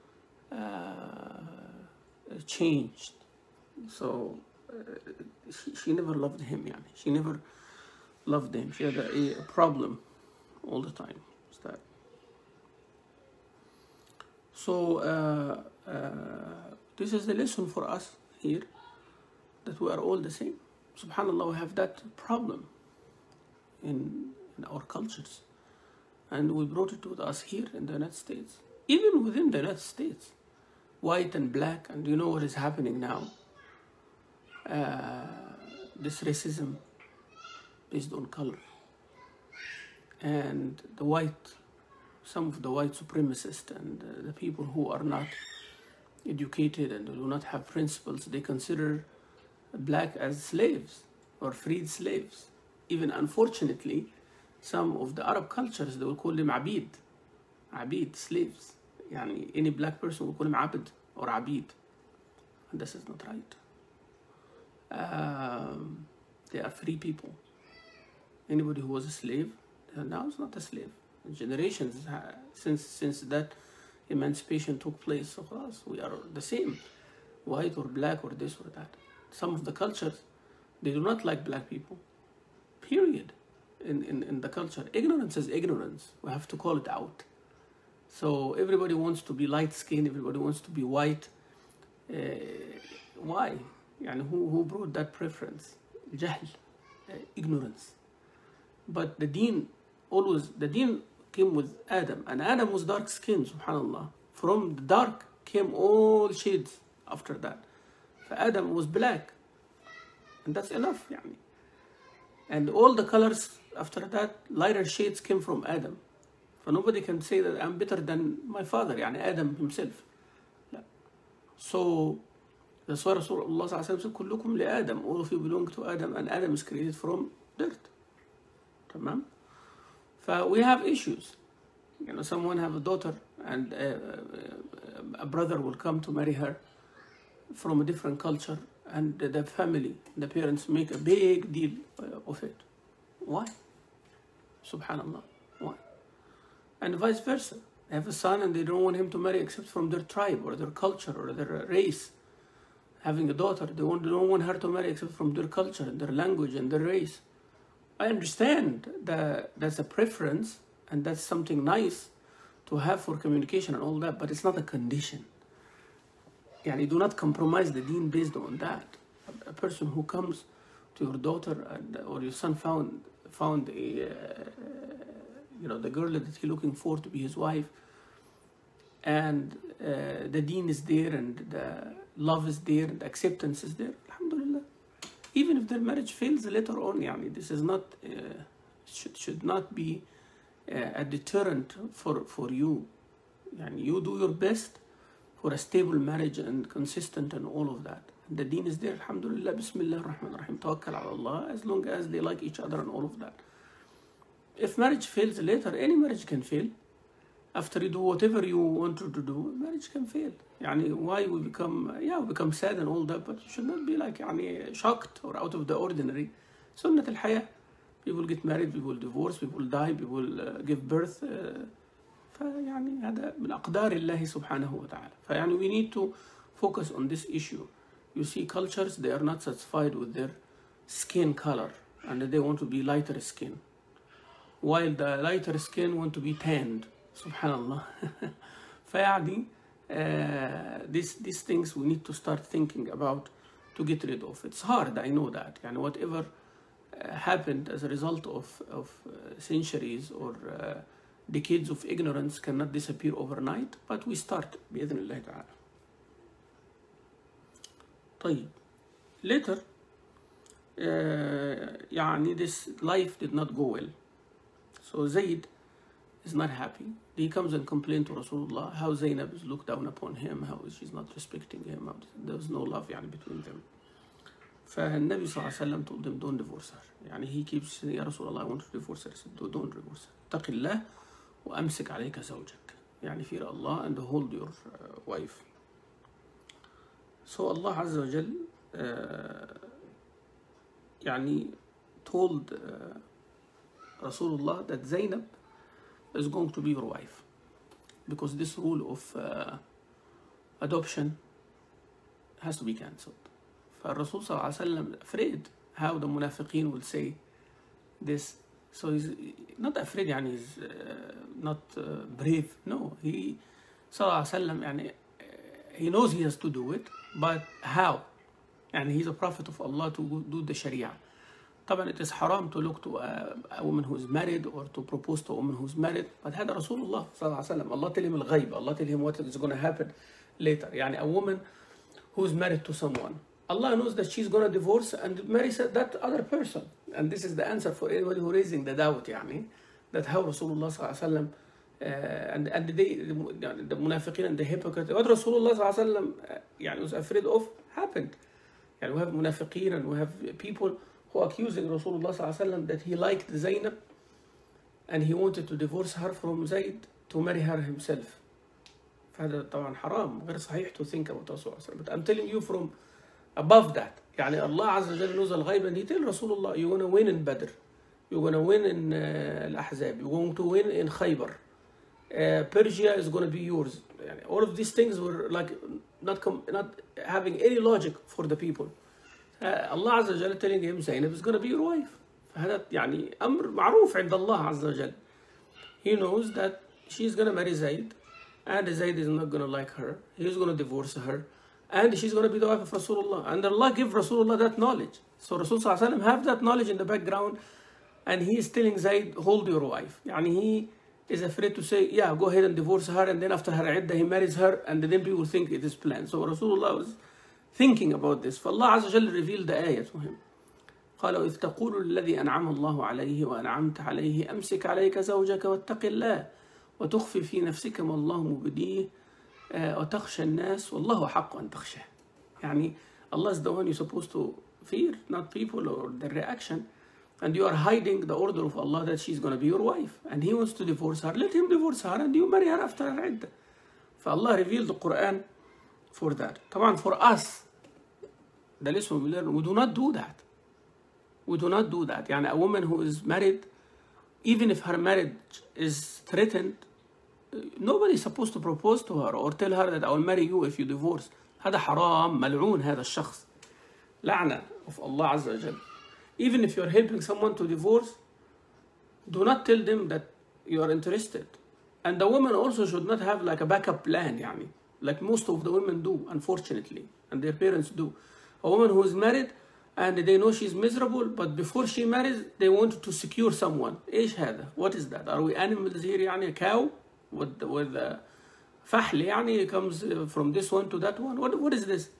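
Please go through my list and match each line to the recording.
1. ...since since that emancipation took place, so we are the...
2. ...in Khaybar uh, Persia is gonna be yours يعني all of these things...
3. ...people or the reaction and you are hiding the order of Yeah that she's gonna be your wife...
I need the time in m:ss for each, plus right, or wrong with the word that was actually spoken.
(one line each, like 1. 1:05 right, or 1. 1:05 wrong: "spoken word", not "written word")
1. 1:12 right
2. 6:10 right
3. 7:05 wrong: "Allah", not "Yeah".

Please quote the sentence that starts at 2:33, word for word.
Having a daughter, they, want, they don't want her to marry except from their culture and their language and their race.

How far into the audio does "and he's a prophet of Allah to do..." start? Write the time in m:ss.
5:18.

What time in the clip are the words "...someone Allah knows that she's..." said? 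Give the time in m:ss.
5:32.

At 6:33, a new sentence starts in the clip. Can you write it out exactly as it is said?
And Allah give Rasulullah that knowledge.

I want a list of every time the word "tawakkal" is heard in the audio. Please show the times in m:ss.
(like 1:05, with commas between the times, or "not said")
3:20.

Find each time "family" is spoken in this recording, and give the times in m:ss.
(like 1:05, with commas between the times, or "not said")
2:19.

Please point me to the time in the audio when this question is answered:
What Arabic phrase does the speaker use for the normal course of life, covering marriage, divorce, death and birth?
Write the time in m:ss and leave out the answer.
3:36.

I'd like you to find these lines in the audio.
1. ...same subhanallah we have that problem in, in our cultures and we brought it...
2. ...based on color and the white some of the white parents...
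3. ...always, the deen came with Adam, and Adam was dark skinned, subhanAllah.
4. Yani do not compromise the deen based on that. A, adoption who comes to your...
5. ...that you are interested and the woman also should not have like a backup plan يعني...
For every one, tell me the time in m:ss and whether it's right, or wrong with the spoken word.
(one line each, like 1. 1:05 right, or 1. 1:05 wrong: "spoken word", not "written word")
1. 0:20 right
2. 0:37 wrong: "supremacists", not "parents"
3. 1:40 right
4. 2:46 wrong: "person", not "adoption"
5. 7:39 right.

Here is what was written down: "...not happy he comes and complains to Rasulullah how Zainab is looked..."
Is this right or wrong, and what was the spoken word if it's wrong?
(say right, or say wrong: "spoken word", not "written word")
right.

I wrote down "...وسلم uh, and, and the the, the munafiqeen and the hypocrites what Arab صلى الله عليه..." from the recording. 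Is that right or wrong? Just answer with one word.
wrong.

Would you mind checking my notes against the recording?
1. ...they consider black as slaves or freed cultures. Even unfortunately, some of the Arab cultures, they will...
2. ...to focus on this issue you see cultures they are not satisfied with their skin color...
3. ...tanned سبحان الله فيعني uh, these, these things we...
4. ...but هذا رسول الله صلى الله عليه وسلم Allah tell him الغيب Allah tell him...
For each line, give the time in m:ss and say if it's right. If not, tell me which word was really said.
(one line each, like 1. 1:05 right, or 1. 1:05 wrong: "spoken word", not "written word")
1. 0:48 wrong: "slaves", not "cultures"
2. 3:45 right
3. 3:56 right
4. 5:26 right.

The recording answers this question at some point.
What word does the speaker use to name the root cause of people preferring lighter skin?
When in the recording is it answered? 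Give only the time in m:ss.
1:36.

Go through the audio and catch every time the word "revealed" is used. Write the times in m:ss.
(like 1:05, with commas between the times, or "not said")
6:49, 7:14.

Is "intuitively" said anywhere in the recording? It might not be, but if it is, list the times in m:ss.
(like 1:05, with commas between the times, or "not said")
not said.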